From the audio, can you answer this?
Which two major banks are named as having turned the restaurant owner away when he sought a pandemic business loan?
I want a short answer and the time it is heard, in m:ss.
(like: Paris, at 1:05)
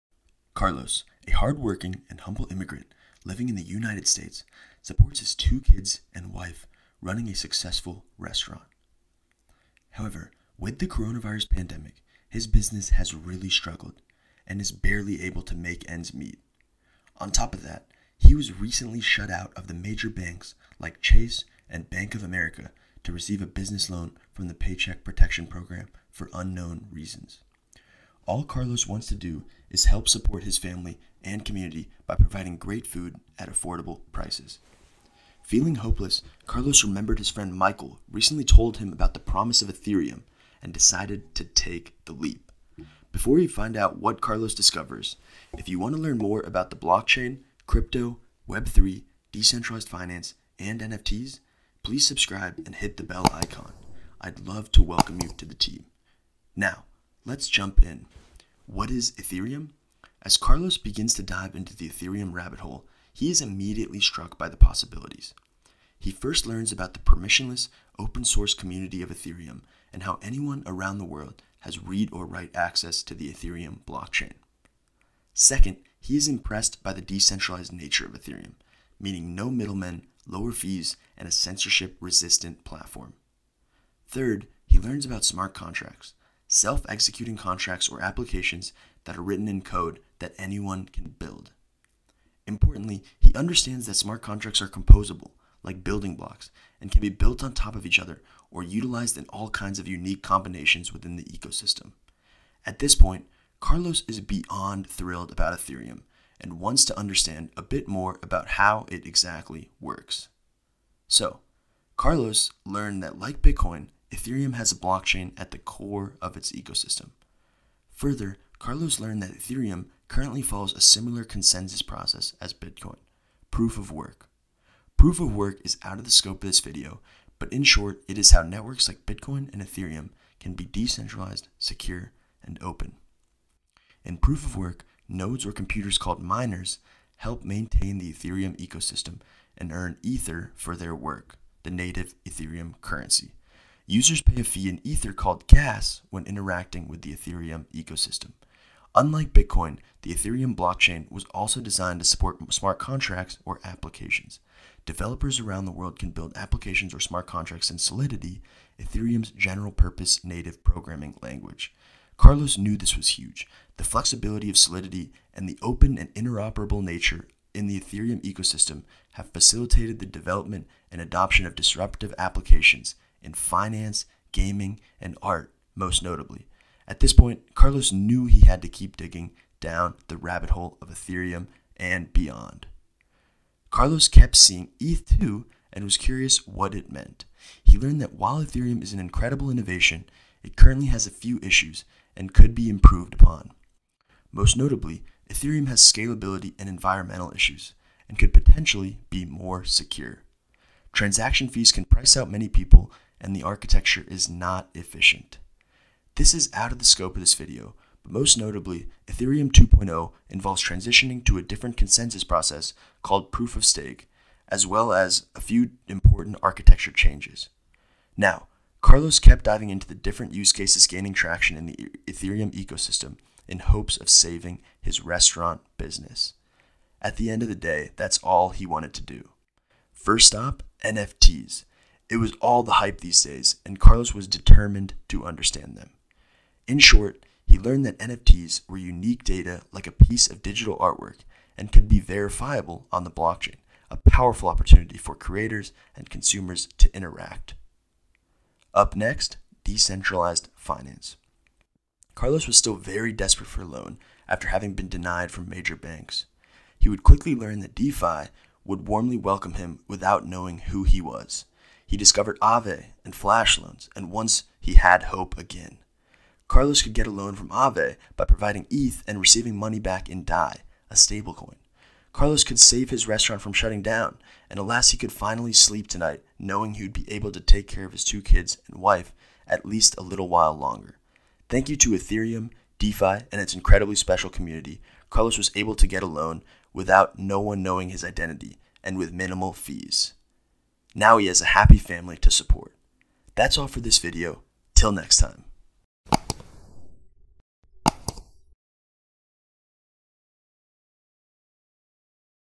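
Chase and Bank of America, at 0:21.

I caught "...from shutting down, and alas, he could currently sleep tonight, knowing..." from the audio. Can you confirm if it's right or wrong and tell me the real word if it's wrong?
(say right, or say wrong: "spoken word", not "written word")
wrong: "finally", not "currently".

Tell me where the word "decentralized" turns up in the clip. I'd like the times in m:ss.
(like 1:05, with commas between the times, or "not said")
0:49, 1:17, 2:10, 4:09.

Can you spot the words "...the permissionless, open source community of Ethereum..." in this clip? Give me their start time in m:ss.
1:06.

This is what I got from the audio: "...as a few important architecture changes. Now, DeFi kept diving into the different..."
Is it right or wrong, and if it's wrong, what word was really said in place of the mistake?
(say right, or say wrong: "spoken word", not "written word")
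wrong: "Carlos", not "DeFi".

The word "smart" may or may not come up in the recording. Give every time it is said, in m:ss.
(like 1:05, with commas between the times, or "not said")
1:25, 1:33, 2:32, 2:36.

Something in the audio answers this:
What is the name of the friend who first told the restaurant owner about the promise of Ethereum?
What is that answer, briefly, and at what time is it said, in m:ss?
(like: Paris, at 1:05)
Michael, at 0:37.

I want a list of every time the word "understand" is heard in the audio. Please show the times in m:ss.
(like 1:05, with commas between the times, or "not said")
1:33, 1:46, 3:55.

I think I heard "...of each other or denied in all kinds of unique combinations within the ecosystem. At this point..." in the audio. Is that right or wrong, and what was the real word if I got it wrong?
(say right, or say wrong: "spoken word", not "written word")
wrong: "utilized", not "denied".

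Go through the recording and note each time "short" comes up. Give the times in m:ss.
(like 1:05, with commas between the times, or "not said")
2:07, 3:56.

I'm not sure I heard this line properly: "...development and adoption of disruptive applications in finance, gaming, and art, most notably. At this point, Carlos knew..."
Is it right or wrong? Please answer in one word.
right.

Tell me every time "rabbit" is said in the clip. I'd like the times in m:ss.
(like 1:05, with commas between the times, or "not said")
1:02, 3:00.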